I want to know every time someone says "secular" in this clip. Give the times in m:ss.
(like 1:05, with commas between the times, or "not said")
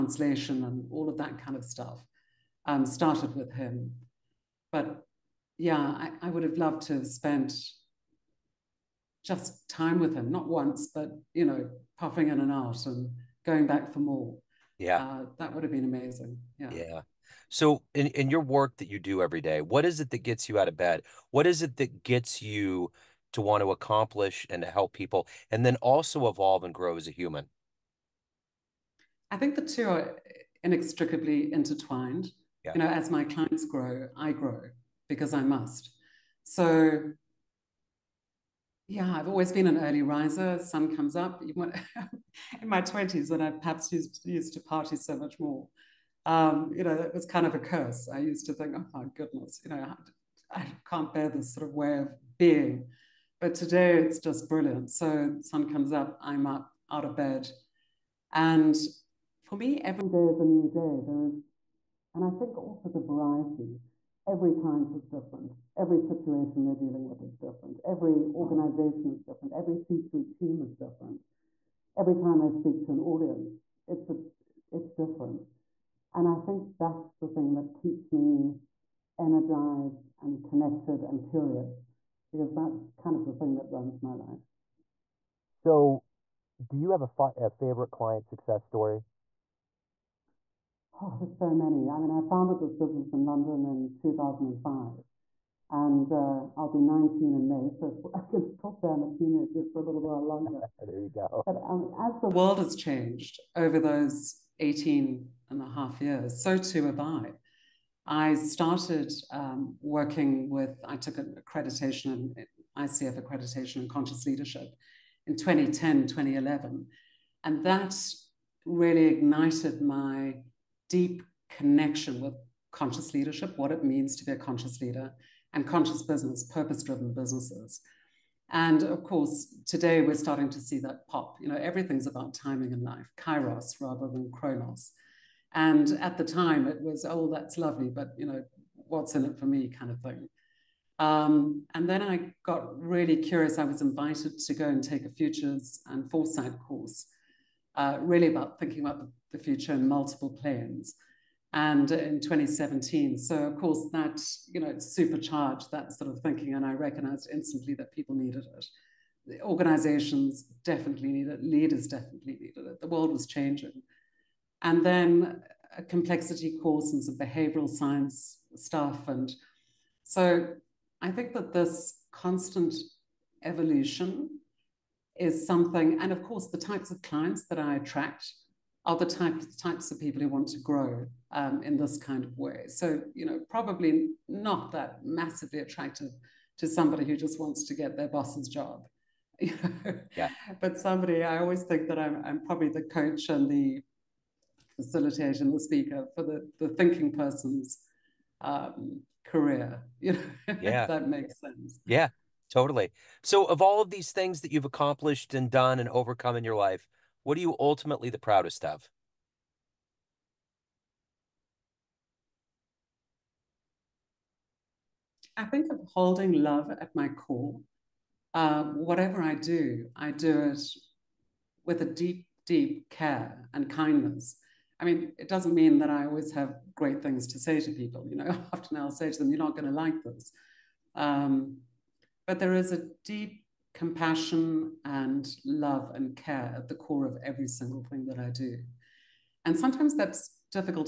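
not said.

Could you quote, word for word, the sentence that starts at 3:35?
I think of holding love at my core.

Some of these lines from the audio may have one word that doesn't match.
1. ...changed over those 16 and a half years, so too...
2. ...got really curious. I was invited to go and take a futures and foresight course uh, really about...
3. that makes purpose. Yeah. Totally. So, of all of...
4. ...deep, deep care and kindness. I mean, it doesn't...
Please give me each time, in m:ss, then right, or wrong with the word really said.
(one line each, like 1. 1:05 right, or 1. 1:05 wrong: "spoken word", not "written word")
1. 1:42 wrong: "18", not "16"
2. 2:22 right
3. 3:20 wrong: "sense", not "purpose"
4. 3:41 right.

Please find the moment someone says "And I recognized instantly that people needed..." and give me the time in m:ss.
2:36.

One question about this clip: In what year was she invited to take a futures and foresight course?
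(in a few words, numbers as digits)
2017.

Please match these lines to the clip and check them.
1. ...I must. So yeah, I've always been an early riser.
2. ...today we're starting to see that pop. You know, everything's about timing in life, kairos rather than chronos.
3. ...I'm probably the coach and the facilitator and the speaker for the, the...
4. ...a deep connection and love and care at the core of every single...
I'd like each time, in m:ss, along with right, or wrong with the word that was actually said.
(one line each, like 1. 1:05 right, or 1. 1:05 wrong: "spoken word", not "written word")
1. 0:35 right
2. 2:09 right
3. 3:12 right
4. 3:52 wrong: "compassion", not "connection".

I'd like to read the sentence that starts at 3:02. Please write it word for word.
So, you know, probably not that massively attractive to somebody who just wants to get their boss's job.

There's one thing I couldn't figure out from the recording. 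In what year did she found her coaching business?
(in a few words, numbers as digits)
2005.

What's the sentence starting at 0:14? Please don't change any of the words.
Yeah, uh, that would have been amazing.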